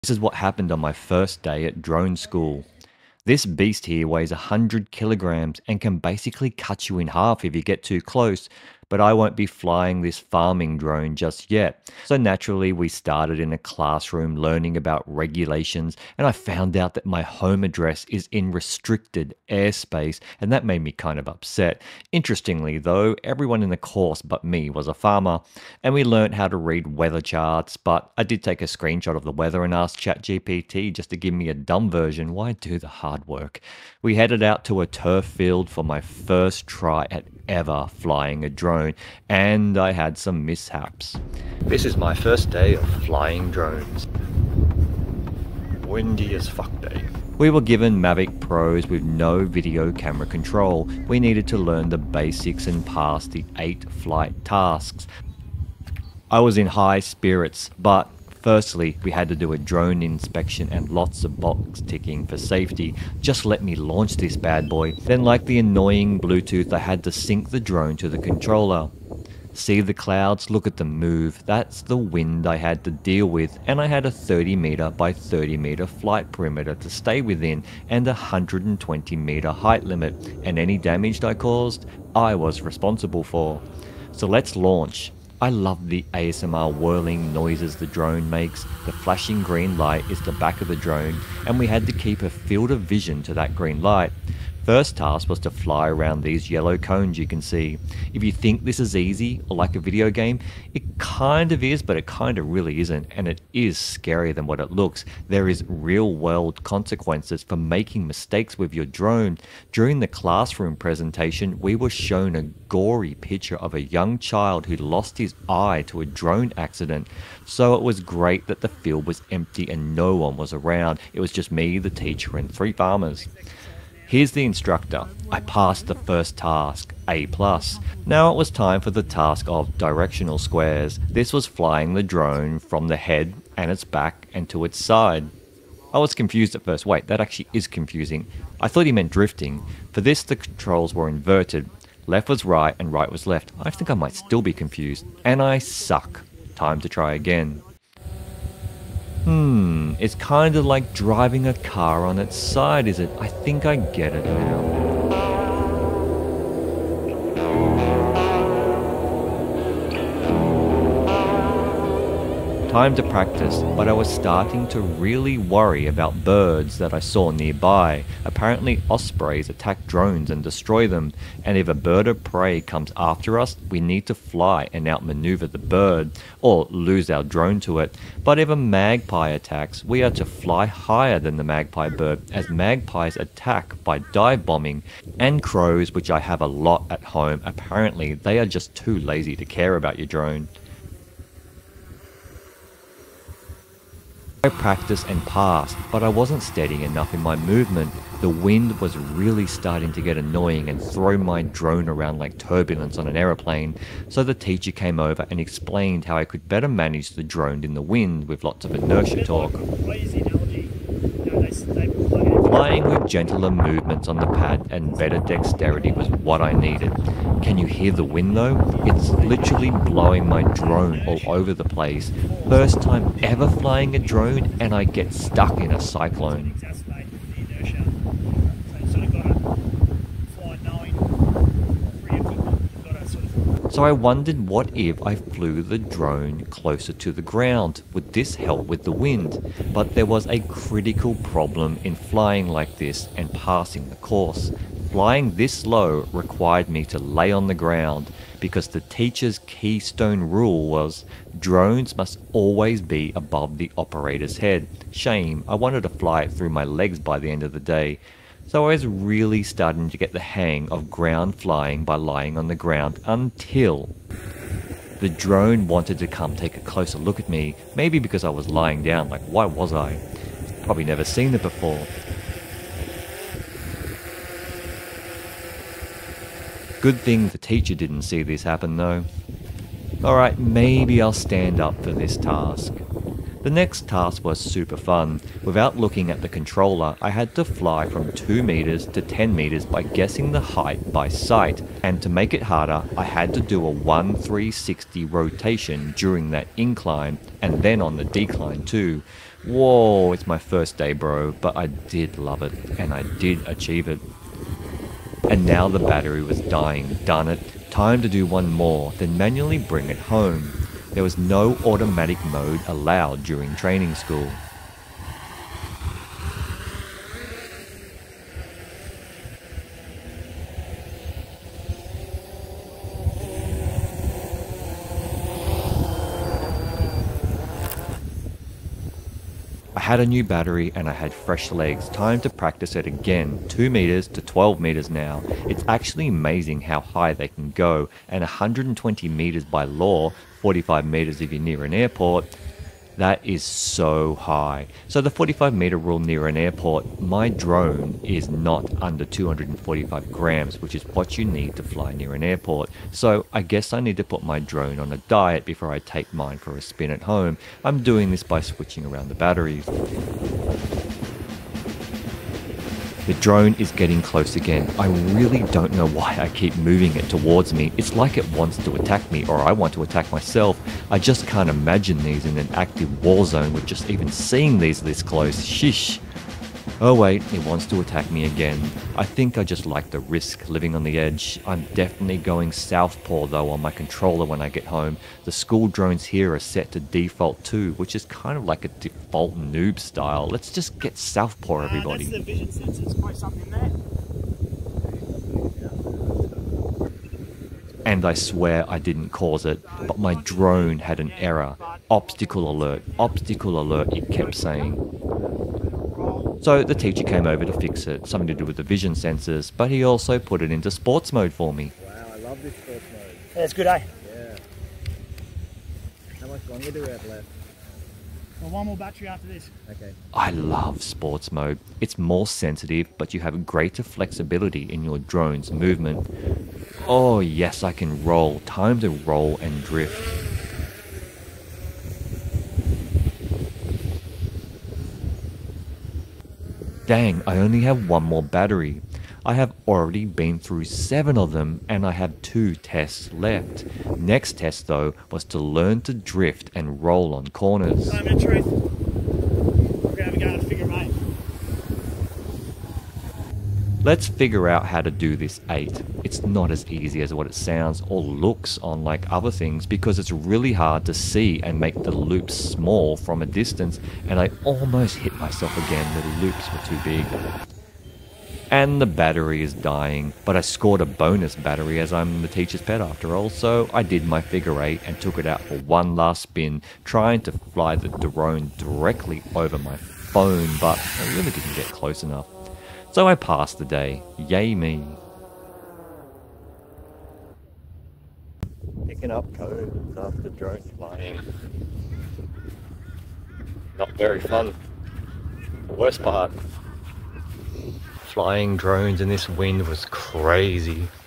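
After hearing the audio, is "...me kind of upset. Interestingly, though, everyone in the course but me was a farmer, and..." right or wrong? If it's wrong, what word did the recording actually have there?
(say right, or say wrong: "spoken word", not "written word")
right.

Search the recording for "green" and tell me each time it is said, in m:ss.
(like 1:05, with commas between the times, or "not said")
1:29, 1:33.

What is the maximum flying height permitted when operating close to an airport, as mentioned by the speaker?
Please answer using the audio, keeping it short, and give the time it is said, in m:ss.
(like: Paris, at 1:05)
45 meters, at 5:40.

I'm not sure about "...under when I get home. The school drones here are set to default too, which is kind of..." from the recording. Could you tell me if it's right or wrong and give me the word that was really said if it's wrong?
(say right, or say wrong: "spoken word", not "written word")
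wrong: "controller", not "under".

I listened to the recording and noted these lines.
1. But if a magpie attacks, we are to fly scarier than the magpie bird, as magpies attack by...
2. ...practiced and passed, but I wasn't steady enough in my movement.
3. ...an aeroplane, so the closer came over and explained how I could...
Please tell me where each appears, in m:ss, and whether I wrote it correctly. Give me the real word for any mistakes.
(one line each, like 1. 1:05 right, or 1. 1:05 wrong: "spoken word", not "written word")
1. 2:58 wrong: "higher", not "scarier"
2. 3:14 right
3. 3:23 wrong: "teacher", not "closer".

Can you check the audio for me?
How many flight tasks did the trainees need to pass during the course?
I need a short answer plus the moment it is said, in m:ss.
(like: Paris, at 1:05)
8, at 0:53.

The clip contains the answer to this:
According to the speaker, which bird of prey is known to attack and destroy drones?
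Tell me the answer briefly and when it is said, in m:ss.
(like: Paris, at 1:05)
Ospreys, at 2:48.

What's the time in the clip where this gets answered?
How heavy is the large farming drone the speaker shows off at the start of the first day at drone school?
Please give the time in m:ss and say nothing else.
0:04.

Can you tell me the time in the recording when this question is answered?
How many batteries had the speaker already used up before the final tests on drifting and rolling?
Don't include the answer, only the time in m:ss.
7:20.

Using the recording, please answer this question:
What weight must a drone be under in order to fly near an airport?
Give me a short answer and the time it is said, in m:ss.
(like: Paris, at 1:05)
245 grams, at 5:49.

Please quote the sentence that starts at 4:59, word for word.
Whoa, it's my first day, bro, but I did love it and I did achieve it.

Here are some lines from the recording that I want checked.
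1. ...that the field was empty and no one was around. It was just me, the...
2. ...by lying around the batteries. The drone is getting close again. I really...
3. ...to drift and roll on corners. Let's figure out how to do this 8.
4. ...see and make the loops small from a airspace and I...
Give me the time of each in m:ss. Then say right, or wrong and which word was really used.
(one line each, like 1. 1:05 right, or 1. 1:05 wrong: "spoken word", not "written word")
1. 1:58 right
2. 5:58 wrong: "switching", not "lying"
3. 7:25 right
4. 7:40 wrong: "distance", not "airspace".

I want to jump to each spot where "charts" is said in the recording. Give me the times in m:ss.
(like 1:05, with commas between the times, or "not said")
0:27.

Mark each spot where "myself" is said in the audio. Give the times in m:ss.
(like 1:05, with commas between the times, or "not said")
6:10, 7:45.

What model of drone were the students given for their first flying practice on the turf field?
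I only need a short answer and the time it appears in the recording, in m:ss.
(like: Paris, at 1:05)
Mavic Pros, at 0:48.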